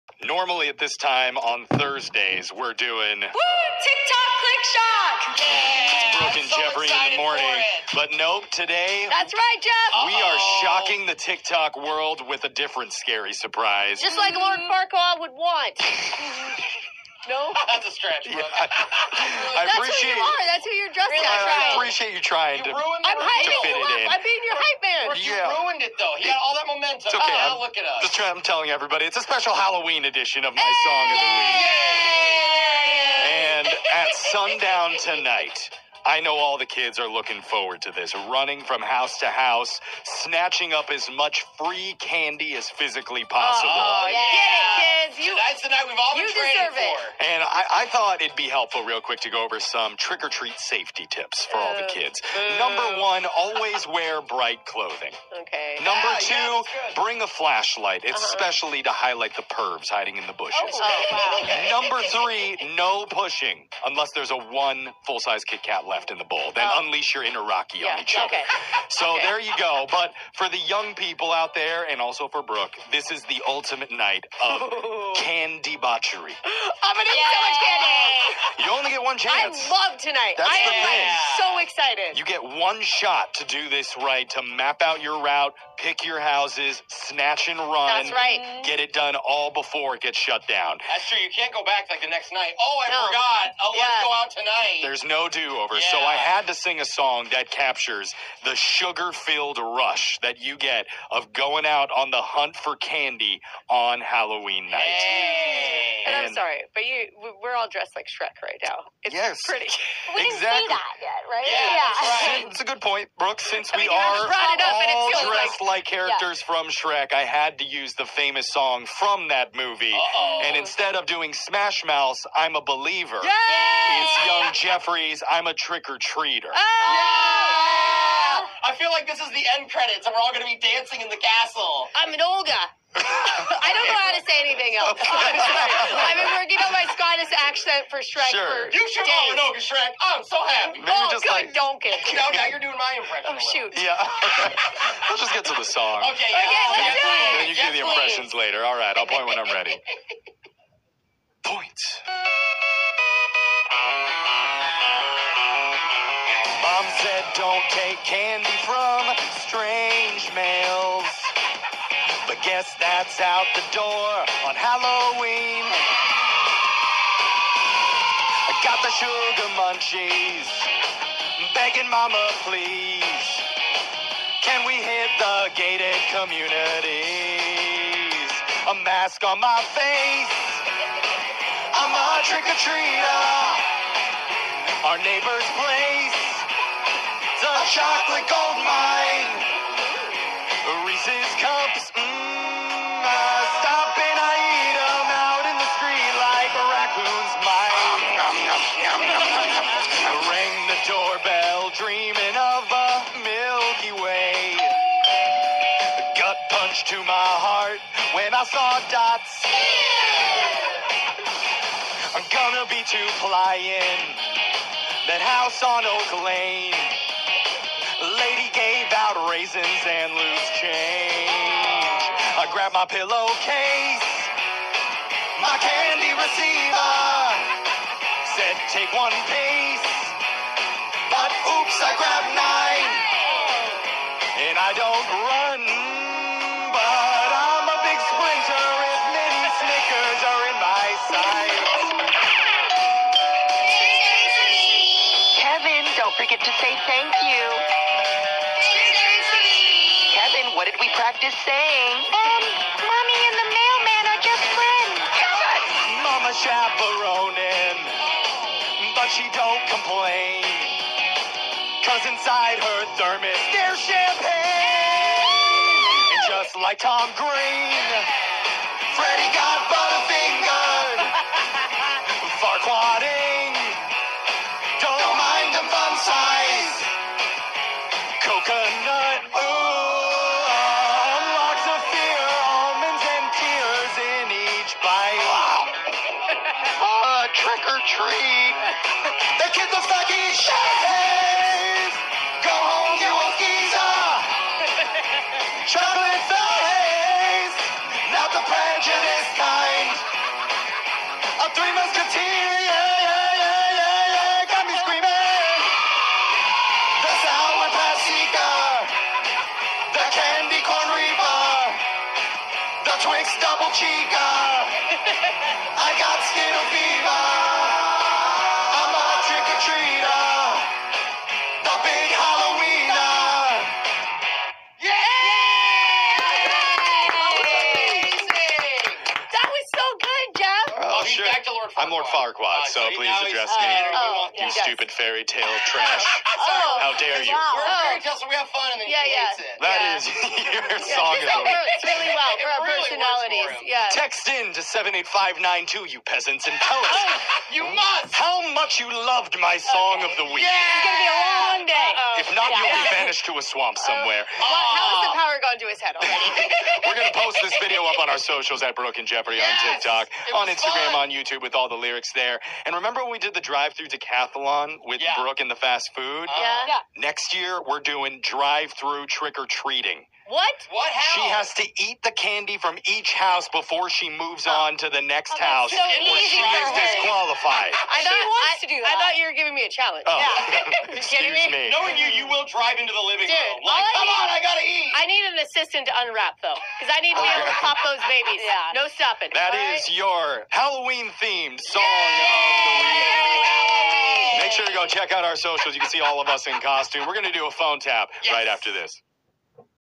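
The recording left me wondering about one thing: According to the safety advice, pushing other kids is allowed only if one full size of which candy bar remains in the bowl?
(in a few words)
Kit Kat.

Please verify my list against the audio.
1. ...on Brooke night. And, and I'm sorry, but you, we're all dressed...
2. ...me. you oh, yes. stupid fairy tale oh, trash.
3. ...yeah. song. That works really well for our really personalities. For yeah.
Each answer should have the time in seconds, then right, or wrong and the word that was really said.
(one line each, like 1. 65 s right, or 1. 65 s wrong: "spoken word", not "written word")
1. 103 s wrong: "Halloween", not "Brooke"
2. 333 s right
3. 340 s right.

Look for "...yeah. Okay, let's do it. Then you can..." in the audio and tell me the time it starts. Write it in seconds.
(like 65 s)
146 s.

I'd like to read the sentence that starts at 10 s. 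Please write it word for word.
are shocking the TikTok world with a different scary surprise.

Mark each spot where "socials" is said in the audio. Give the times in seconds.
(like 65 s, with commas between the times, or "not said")
358 s, 395 s.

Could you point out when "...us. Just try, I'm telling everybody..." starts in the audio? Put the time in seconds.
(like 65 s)
27 s.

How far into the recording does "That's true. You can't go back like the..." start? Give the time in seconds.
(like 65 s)
90 s.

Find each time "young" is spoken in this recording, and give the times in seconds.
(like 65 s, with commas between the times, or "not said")
70 s, 124 s.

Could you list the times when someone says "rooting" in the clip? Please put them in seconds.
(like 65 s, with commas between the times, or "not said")
not said.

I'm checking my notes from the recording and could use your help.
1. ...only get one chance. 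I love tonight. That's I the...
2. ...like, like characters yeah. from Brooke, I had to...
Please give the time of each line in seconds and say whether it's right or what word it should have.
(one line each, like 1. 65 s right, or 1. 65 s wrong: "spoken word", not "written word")
1. 78 s right
2. 115 s wrong: "Shrek", not "Brooke".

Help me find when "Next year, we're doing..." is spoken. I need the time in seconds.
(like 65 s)
366 s.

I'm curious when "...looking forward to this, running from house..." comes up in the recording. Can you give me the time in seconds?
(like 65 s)
37 s.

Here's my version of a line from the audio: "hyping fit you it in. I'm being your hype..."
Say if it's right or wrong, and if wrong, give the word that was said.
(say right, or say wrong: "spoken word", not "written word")
right.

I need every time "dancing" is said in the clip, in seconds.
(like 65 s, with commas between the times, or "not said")
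130 s.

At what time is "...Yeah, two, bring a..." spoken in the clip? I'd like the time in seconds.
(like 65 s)
56 s.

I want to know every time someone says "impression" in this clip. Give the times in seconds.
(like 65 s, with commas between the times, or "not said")
142 s, 147 s.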